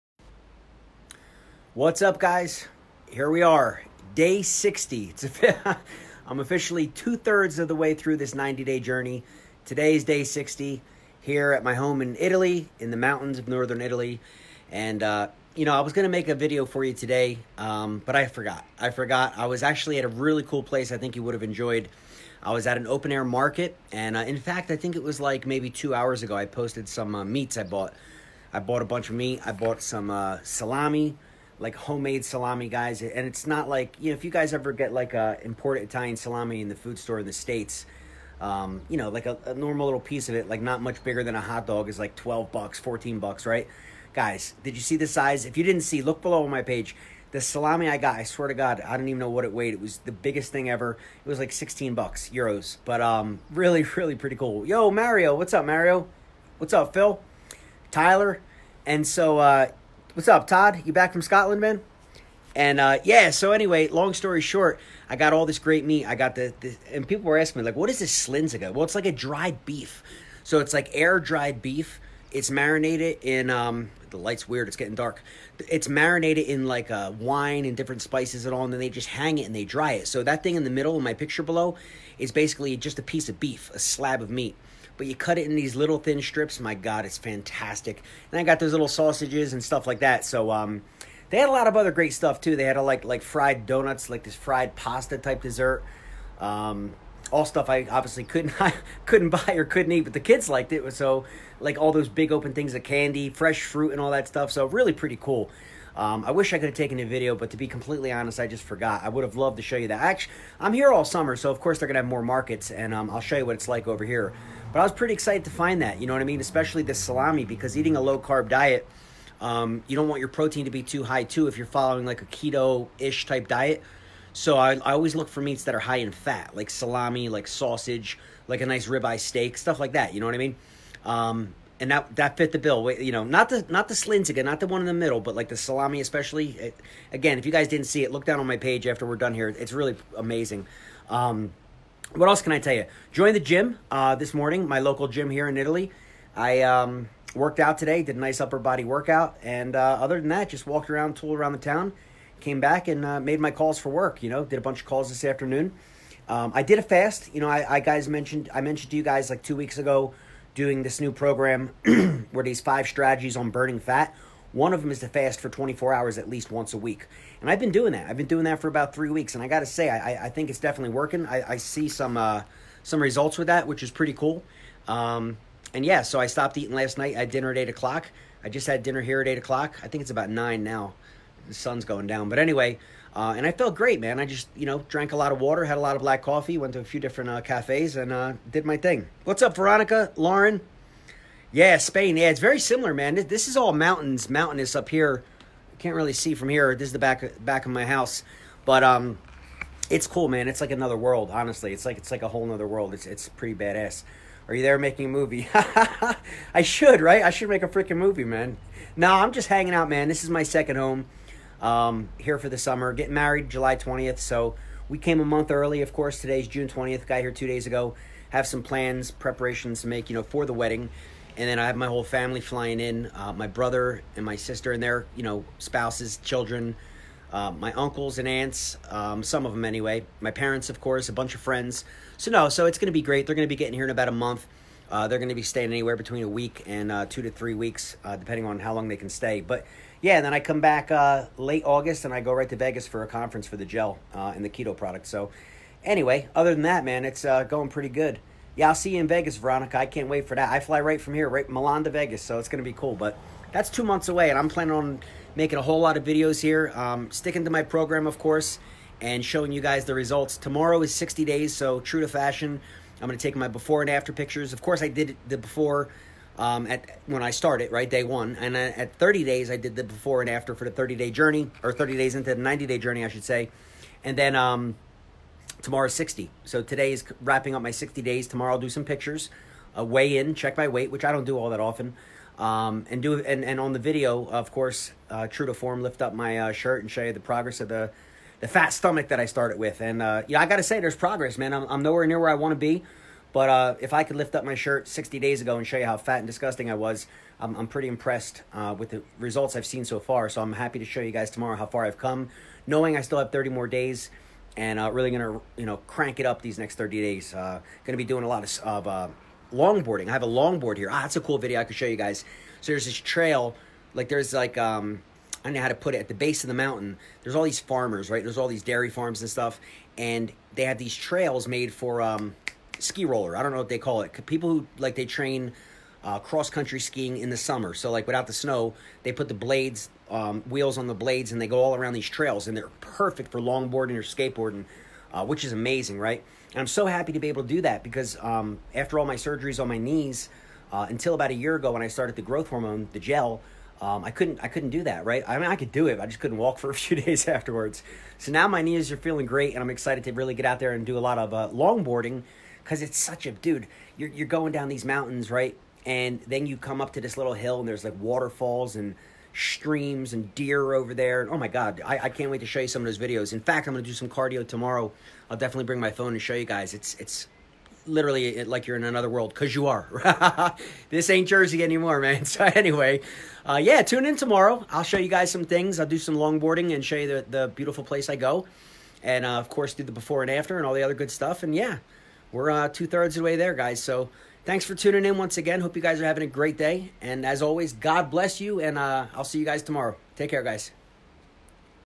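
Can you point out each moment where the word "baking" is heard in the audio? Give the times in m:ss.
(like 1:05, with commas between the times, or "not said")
not said.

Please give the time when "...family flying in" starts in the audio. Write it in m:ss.
3:42.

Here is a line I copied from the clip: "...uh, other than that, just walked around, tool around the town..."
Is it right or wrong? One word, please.
right.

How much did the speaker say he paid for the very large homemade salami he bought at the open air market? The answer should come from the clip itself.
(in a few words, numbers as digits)
16 euros.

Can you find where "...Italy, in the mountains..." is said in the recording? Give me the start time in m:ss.
0:12.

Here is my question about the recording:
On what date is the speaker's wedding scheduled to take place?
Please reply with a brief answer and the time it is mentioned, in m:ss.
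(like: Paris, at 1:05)
July 20th, at 3:33.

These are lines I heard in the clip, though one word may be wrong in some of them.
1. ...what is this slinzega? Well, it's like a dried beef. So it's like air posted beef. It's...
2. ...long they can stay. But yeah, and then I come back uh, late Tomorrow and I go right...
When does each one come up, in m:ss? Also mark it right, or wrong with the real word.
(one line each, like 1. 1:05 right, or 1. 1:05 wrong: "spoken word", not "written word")
1. 1:07 wrong: "dried", not "posted"
2. 3:58 wrong: "August", not "Tomorrow".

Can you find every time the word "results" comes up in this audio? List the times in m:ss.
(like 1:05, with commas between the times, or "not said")
2:53, 4:19, 4:59.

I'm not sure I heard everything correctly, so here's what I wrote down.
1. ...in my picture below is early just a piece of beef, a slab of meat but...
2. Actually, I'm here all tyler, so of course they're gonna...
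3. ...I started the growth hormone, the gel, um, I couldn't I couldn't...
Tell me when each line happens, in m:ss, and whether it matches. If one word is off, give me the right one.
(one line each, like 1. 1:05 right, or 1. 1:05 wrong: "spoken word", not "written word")
1. 1:20 wrong: "basically", not "early"
2. 1:49 wrong: "summer", not "tyler"
3. 5:41 right.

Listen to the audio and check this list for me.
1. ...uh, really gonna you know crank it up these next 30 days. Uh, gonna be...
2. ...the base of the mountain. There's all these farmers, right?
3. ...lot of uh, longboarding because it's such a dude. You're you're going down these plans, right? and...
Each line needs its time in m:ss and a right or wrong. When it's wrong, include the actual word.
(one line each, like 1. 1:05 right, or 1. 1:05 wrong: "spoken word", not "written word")
1. 5:04 right
2. 5:16 right
3. 5:50 wrong: "mountains", not "plans".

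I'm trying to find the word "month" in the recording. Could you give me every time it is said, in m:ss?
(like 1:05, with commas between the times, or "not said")
3:35, 3:54, 4:13.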